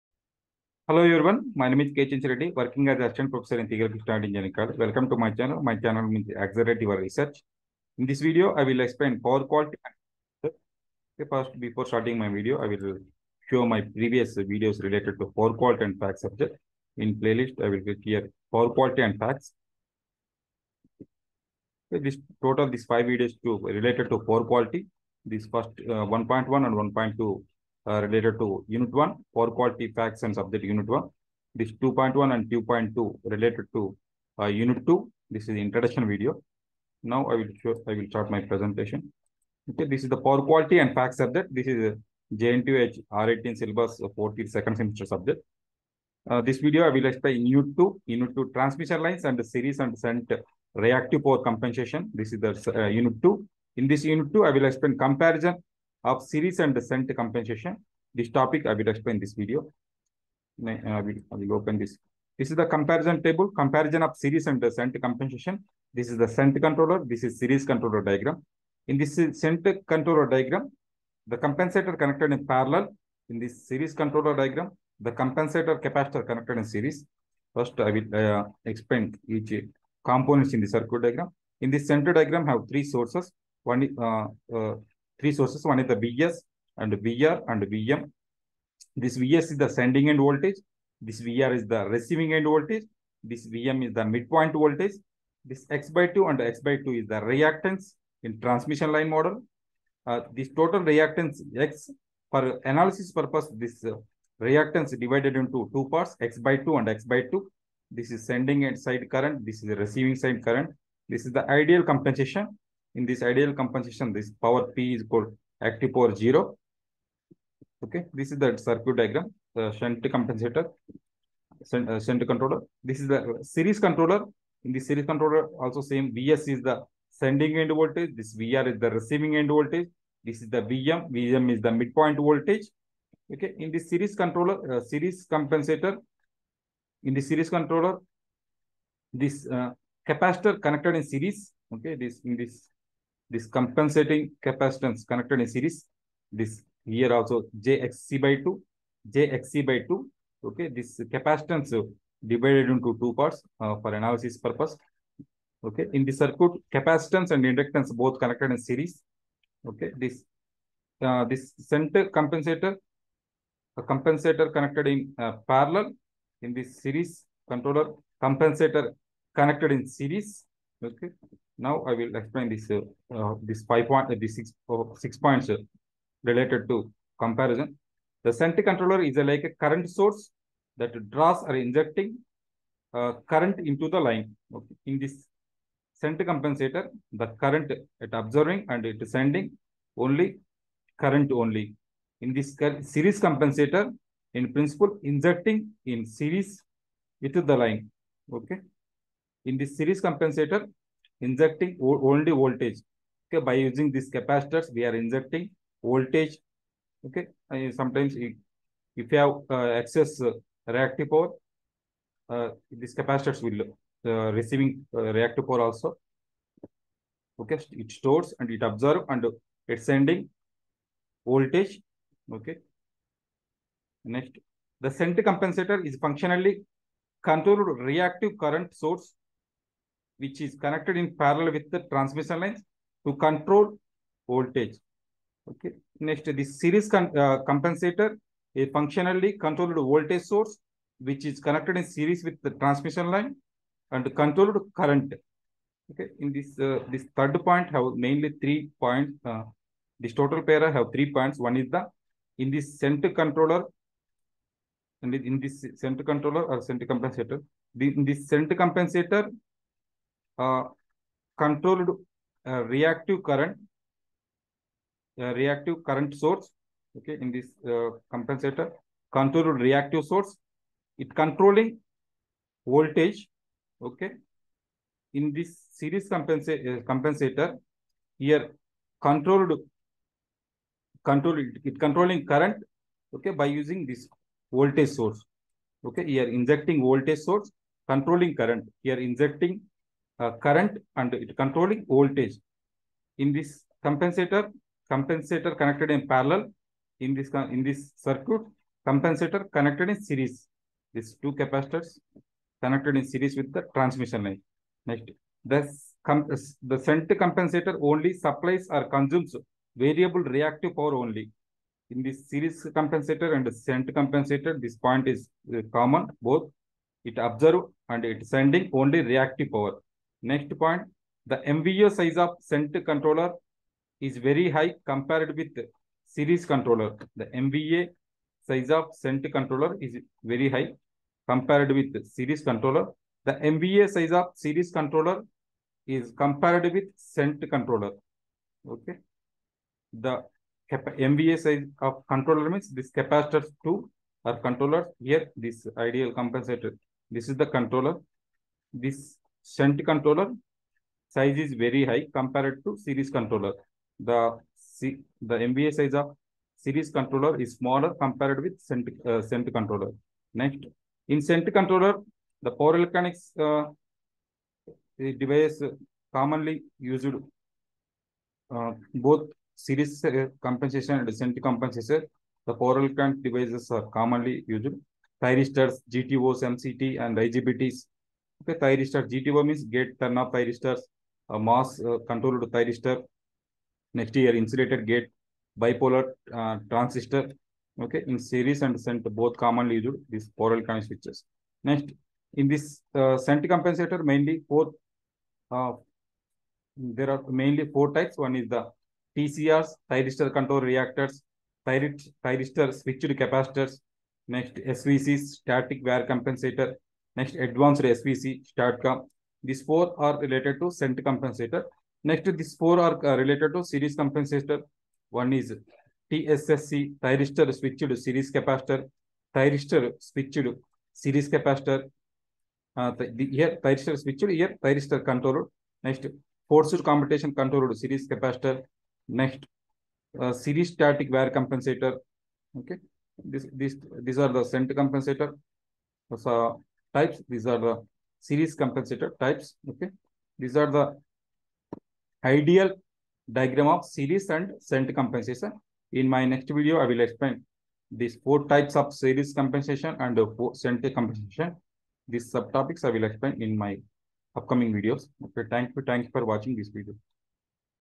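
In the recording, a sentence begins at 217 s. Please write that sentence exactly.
Okay, it stores and it absorbs and it's sending voltage.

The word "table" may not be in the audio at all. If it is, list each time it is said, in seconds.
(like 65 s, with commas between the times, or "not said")
63 s.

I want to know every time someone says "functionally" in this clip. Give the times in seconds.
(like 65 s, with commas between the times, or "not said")
225 s, 238 s.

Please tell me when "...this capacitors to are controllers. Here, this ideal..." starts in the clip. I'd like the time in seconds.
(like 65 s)
342 s.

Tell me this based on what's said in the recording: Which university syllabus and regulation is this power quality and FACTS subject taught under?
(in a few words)
JNTUH R18.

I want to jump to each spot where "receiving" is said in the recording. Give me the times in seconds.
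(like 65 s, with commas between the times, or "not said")
91 s, 109 s, 128 s, 214 s.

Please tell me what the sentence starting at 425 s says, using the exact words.
Next, forced commutation controlled series capacitor.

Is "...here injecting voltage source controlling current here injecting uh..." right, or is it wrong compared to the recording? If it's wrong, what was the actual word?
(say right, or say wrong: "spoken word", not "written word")
right.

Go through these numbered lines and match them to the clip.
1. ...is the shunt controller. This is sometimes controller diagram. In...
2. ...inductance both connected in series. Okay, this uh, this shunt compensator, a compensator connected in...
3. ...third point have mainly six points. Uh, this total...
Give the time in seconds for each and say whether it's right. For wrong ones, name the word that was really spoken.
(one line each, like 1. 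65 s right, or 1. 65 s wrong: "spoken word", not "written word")
1. 66 s wrong: "series", not "sometimes"
2. 157 s right
3. 247 s wrong: "three", not "six".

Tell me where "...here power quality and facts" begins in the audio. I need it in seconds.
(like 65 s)
18 s.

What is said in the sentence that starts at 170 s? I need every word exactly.
Okay, now I will explain this uh, this five point uh, this six uh, six points uh, related to comparison.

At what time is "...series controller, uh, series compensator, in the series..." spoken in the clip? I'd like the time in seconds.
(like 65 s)
133 s.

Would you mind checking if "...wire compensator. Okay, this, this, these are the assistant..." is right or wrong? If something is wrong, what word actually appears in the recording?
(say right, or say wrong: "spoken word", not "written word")
wrong: "scent", not "assistant".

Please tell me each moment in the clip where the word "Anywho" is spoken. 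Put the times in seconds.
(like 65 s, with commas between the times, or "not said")
not said.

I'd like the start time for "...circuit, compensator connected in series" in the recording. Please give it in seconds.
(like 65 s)
298 s.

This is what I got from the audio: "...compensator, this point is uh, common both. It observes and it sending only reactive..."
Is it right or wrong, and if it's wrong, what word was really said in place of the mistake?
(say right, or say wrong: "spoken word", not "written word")
right.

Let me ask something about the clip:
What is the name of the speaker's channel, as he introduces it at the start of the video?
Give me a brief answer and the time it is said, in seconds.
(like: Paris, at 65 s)
Accelerate your research, at 6 s.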